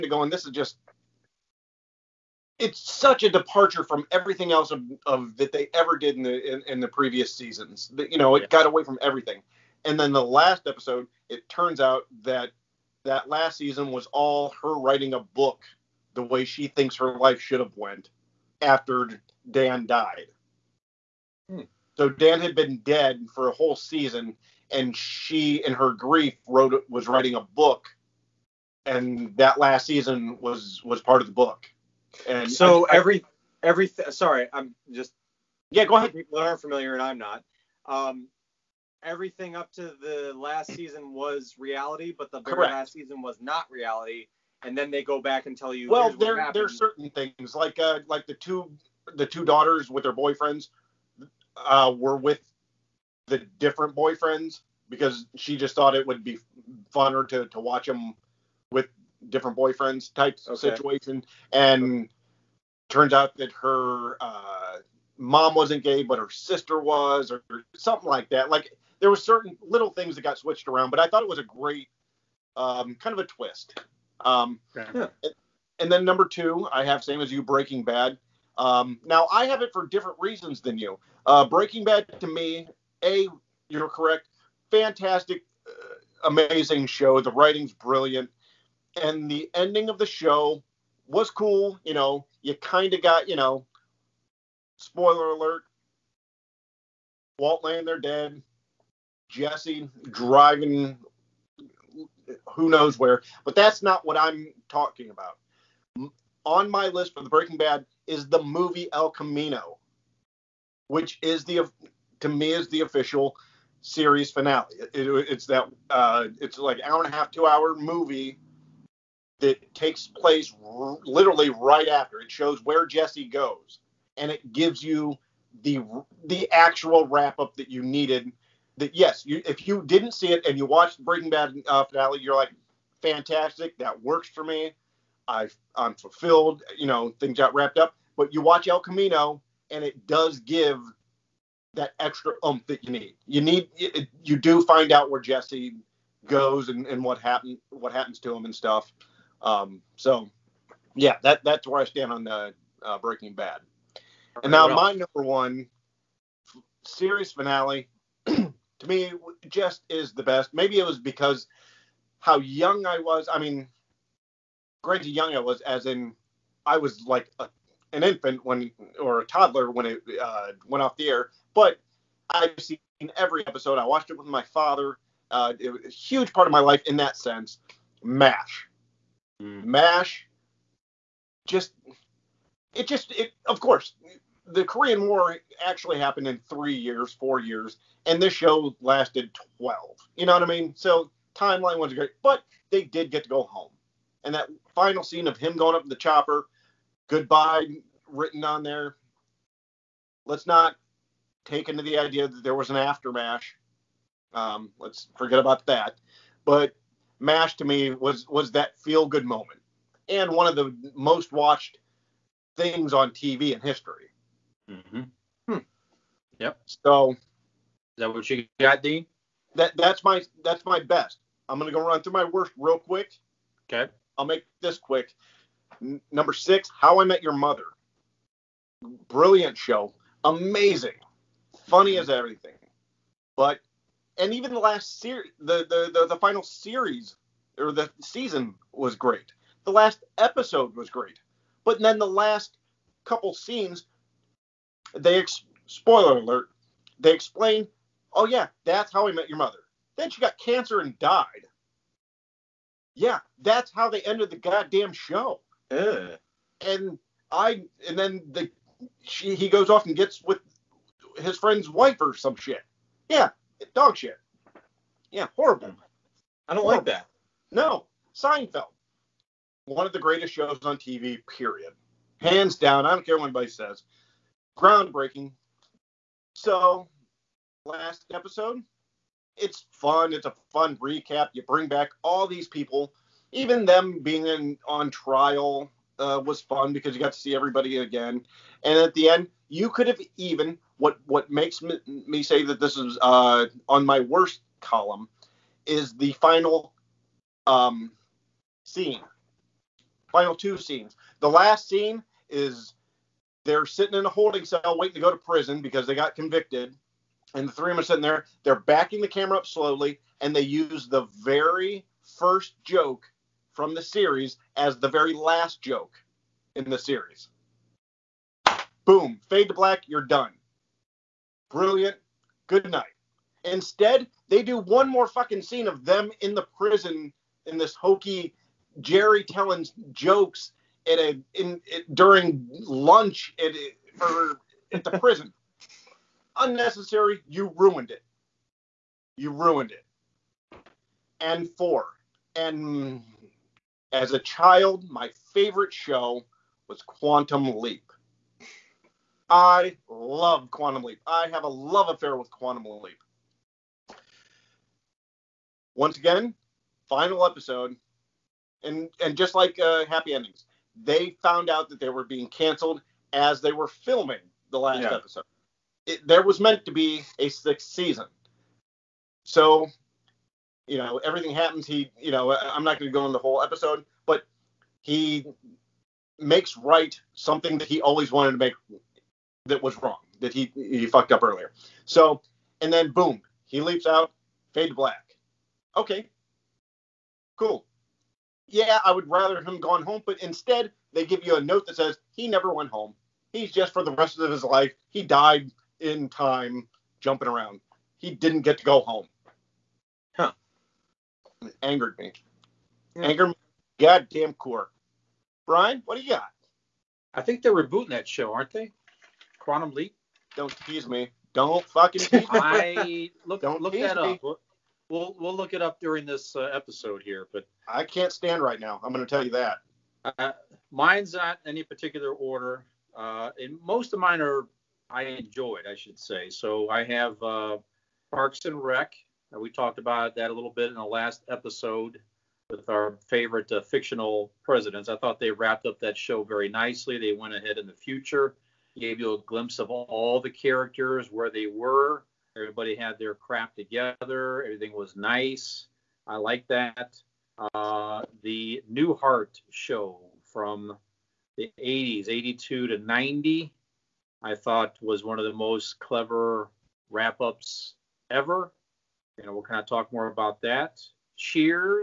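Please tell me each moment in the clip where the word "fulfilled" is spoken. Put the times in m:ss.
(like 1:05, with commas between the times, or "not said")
2:15.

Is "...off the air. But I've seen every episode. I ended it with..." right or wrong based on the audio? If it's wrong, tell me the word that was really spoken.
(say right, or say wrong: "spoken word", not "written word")
wrong: "watched", not "ended".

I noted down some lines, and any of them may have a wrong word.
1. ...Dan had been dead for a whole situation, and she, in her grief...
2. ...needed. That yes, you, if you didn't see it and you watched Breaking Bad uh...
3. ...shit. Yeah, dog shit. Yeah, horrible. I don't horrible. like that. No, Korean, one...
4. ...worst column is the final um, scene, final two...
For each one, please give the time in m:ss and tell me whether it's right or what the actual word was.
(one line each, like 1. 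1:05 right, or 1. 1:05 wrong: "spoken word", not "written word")
1. 0:22 wrong: "season", not "situation"
2. 2:07 right
3. 4:22 wrong: "Seinfeld", not "Korean"
4. 4:54 right.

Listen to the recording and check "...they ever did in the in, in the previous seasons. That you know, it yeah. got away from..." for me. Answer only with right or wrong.
right.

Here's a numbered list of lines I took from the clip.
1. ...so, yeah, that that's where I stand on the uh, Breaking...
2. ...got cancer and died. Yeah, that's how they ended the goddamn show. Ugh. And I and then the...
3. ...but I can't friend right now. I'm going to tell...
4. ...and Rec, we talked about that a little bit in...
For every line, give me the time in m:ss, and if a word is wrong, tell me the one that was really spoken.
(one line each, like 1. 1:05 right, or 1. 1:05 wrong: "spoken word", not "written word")
1. 2:29 right
2. 4:10 right
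3. 6:57 wrong: "stand", not "friend"
4. 7:08 right.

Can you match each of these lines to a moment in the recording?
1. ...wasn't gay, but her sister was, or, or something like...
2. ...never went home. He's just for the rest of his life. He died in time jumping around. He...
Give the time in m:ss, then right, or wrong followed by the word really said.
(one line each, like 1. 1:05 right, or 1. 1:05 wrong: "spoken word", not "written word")
1. 1:05 right
2. 6:32 right.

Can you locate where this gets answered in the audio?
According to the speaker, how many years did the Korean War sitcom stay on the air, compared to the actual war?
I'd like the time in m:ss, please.
3:09.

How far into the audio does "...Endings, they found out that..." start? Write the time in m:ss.
6:00.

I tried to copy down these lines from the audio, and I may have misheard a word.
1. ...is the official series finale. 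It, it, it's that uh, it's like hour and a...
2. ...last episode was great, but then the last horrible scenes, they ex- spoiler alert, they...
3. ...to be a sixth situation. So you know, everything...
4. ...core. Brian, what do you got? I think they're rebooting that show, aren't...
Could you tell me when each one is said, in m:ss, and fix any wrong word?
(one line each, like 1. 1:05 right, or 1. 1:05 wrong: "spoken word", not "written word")
1. 1:52 right
2. 3:59 wrong: "couple", not "horrible"
3. 6:06 wrong: "season", not "situation"
4. 6:44 right.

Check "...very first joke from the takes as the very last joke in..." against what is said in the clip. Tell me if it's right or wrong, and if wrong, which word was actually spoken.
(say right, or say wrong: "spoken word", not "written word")
wrong: "series", not "takes".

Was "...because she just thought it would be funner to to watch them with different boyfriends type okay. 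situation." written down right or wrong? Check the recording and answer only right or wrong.
right.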